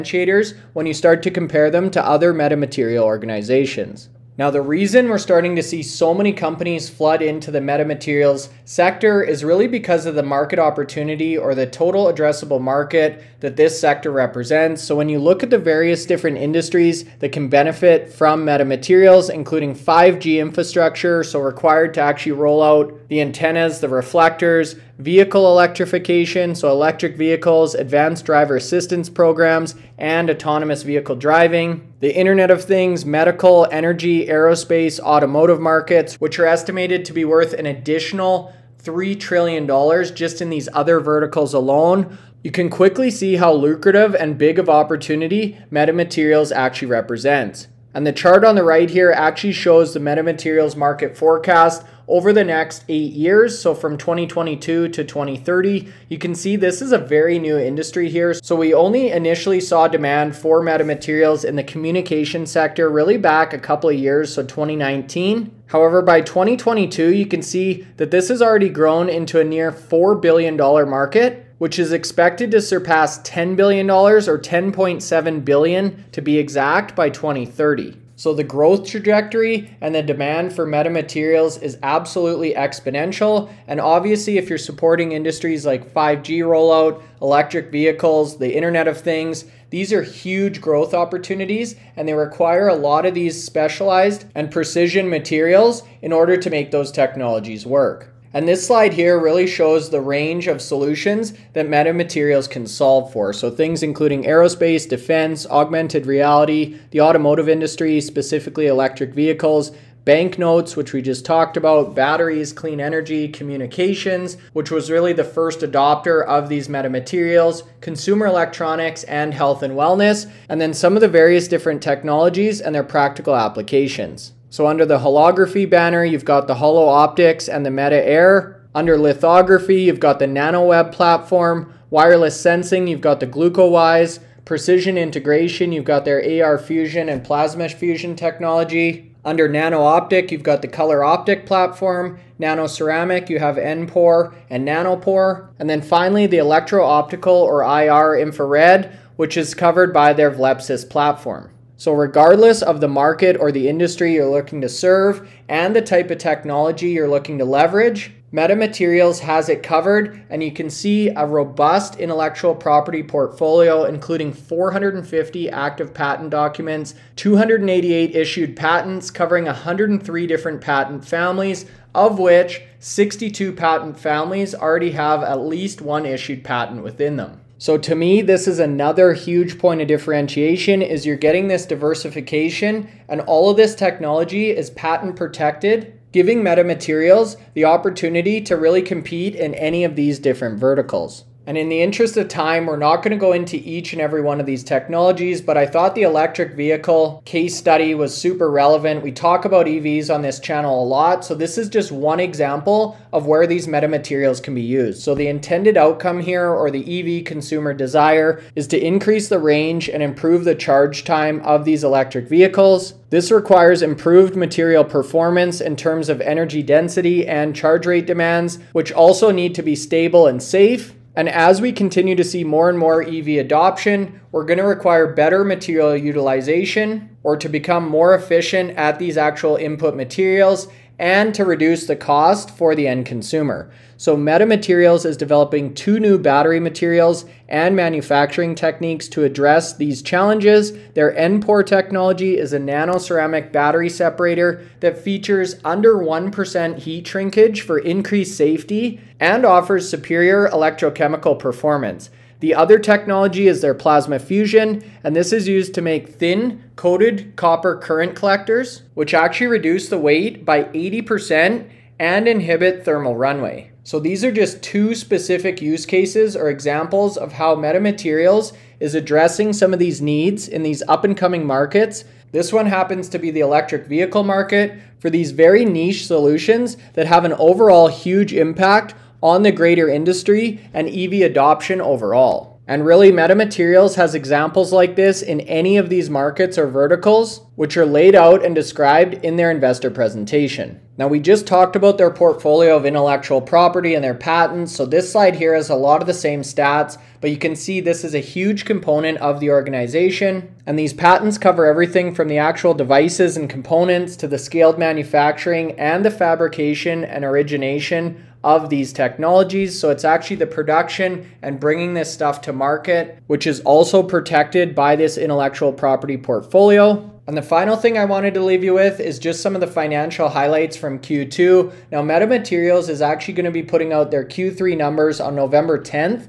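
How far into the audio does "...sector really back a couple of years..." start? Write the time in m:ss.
1:02.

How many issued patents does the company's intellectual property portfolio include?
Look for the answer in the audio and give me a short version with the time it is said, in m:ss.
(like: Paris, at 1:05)
288, at 2:47.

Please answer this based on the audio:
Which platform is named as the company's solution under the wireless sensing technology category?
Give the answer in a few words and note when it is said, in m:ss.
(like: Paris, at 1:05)
GlucoWise, at 2:13.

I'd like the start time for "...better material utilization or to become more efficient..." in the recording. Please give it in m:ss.
3:45.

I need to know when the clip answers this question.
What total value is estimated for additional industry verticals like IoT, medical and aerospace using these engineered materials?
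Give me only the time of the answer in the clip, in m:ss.
0:38.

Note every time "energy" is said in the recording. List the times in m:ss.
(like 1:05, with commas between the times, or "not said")
0:33, 1:52, 3:36.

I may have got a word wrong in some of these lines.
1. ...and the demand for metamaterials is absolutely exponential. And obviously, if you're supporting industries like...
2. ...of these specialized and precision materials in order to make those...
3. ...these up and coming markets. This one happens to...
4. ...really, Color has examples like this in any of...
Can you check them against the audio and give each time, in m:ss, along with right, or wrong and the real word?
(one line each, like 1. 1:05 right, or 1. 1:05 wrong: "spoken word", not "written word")
1. 1:19 right
2. 1:33 right
3. 4:30 right
4. 4:42 wrong: "Metamaterials", not "Color".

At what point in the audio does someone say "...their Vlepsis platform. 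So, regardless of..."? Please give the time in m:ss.
2:30.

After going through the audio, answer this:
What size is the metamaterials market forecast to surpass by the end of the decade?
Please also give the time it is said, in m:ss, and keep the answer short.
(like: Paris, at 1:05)
10.7 billion, at 1:14.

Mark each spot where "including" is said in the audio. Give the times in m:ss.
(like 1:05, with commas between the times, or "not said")
0:19, 1:43, 2:43.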